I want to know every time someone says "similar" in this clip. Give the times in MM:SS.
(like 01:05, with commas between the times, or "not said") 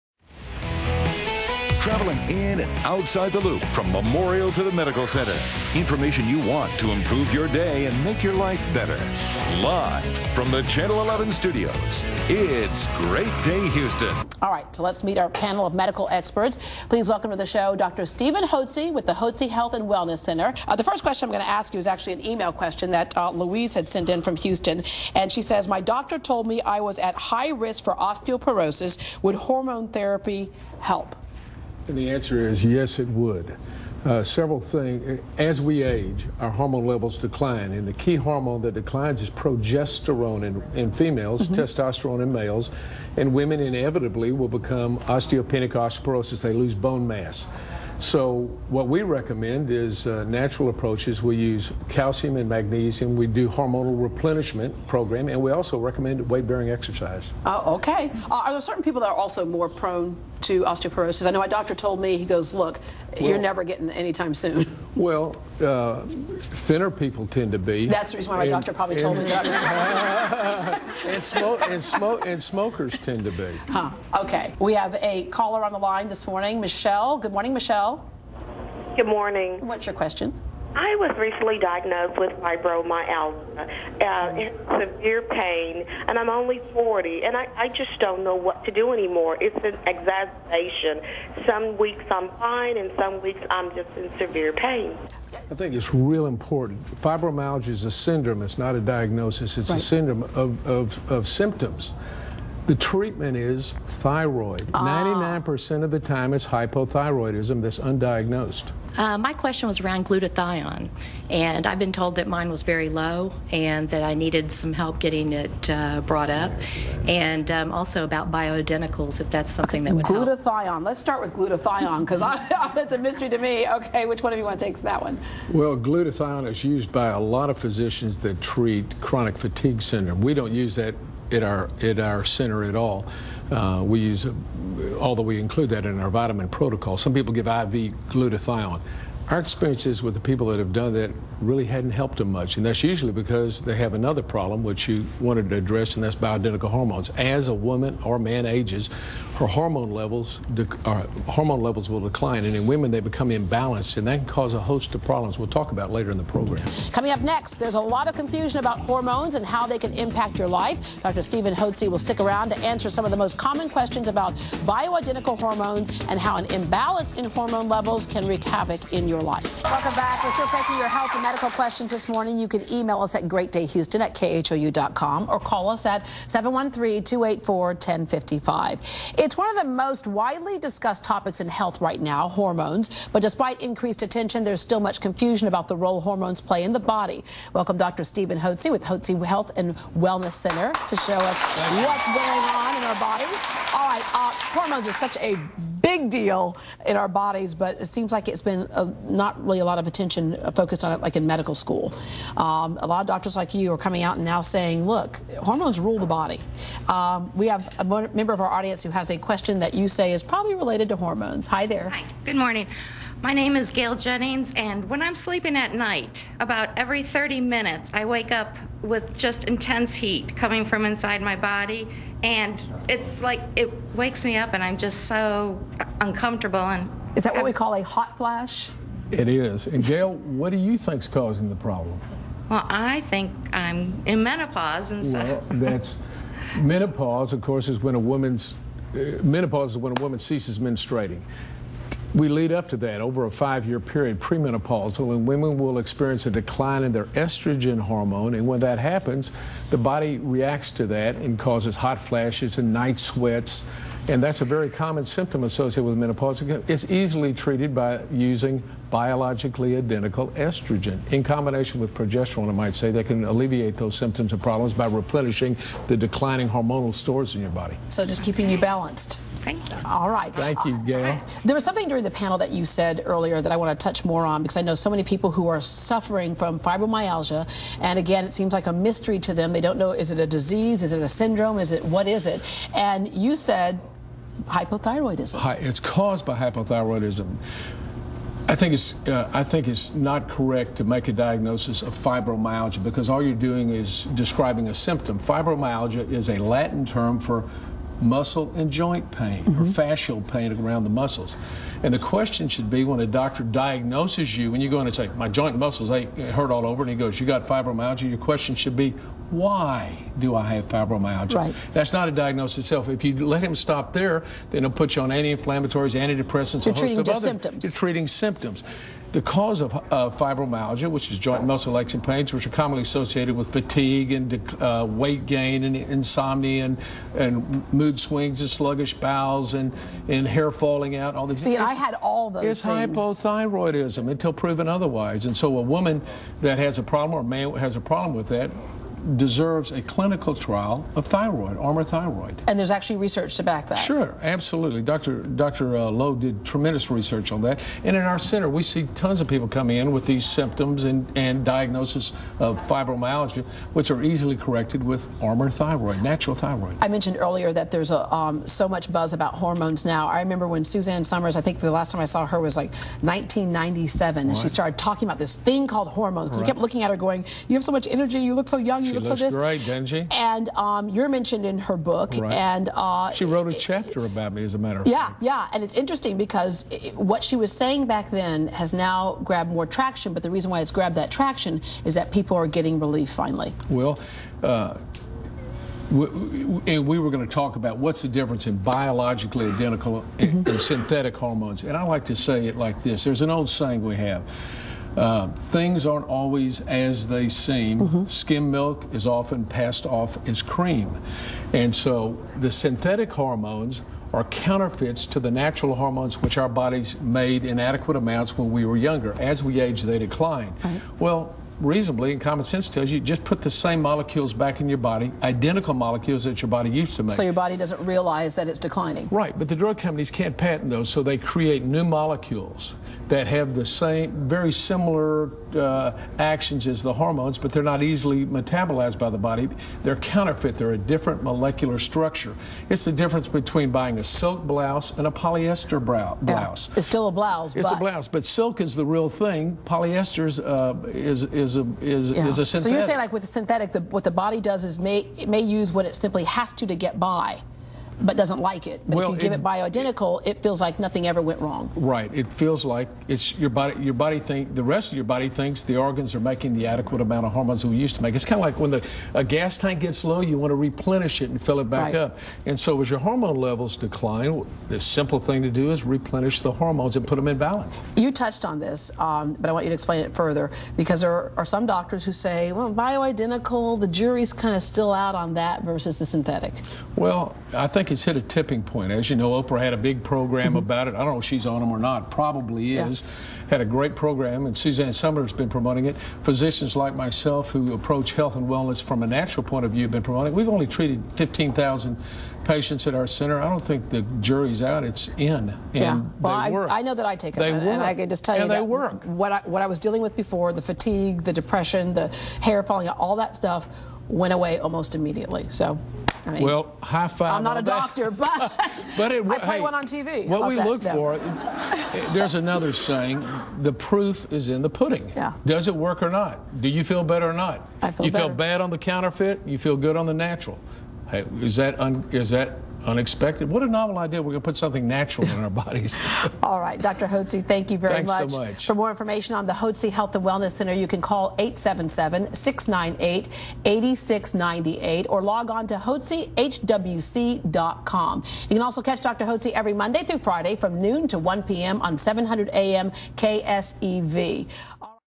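07:04.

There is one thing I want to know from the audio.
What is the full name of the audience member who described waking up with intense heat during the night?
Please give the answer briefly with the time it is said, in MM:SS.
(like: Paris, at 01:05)
Gail Jennings, at 03:33.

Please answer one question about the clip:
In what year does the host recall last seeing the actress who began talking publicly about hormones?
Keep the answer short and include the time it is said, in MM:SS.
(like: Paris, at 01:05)
1997, at 06:03.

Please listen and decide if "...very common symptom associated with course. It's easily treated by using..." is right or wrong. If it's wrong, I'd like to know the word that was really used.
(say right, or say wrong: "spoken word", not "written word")
wrong: "menopause", not "course".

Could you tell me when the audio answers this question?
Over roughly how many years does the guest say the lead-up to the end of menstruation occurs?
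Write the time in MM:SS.
04:03.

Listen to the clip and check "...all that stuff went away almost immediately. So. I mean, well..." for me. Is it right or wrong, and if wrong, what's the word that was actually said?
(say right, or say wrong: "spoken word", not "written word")
right.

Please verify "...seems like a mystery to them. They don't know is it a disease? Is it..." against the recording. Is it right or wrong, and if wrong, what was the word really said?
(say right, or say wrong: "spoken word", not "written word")
right.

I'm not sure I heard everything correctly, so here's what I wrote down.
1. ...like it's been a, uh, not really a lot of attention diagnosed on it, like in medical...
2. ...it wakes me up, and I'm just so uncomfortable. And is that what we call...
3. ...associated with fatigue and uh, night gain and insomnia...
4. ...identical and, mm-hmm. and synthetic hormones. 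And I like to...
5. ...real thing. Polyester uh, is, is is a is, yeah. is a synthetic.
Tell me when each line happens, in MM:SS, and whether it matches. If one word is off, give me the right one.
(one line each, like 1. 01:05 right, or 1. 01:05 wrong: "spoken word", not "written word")
1. 03:18 wrong: "focused", not "diagnosed"
2. 03:43 right
3. 05:22 wrong: "weight", not "night"
4. 06:29 right
5. 07:18 right.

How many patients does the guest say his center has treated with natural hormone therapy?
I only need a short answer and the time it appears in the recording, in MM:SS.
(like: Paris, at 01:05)
15,000, at 08:11.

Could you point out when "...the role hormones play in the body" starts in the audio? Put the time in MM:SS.
03:05.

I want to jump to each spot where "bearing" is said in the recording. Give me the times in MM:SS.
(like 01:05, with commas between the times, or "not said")
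00:56.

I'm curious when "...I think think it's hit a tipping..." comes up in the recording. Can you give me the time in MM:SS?
07:57.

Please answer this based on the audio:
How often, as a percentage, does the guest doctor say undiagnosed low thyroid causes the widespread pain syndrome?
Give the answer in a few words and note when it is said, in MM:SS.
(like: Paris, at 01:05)
99%, at 01:44.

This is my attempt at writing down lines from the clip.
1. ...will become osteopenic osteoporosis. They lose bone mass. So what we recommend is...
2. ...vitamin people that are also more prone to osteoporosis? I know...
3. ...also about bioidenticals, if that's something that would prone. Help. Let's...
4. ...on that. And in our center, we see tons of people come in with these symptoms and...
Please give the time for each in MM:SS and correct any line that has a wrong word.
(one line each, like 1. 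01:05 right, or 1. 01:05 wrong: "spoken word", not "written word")
1. 00:44 right
2. 00:58 wrong: "certain", not "vitamin"
3. 01:57 wrong: "glutathione", not "prone"
4. 05:47 right.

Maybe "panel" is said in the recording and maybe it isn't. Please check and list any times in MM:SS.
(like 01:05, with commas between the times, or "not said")
00:15, 04:32.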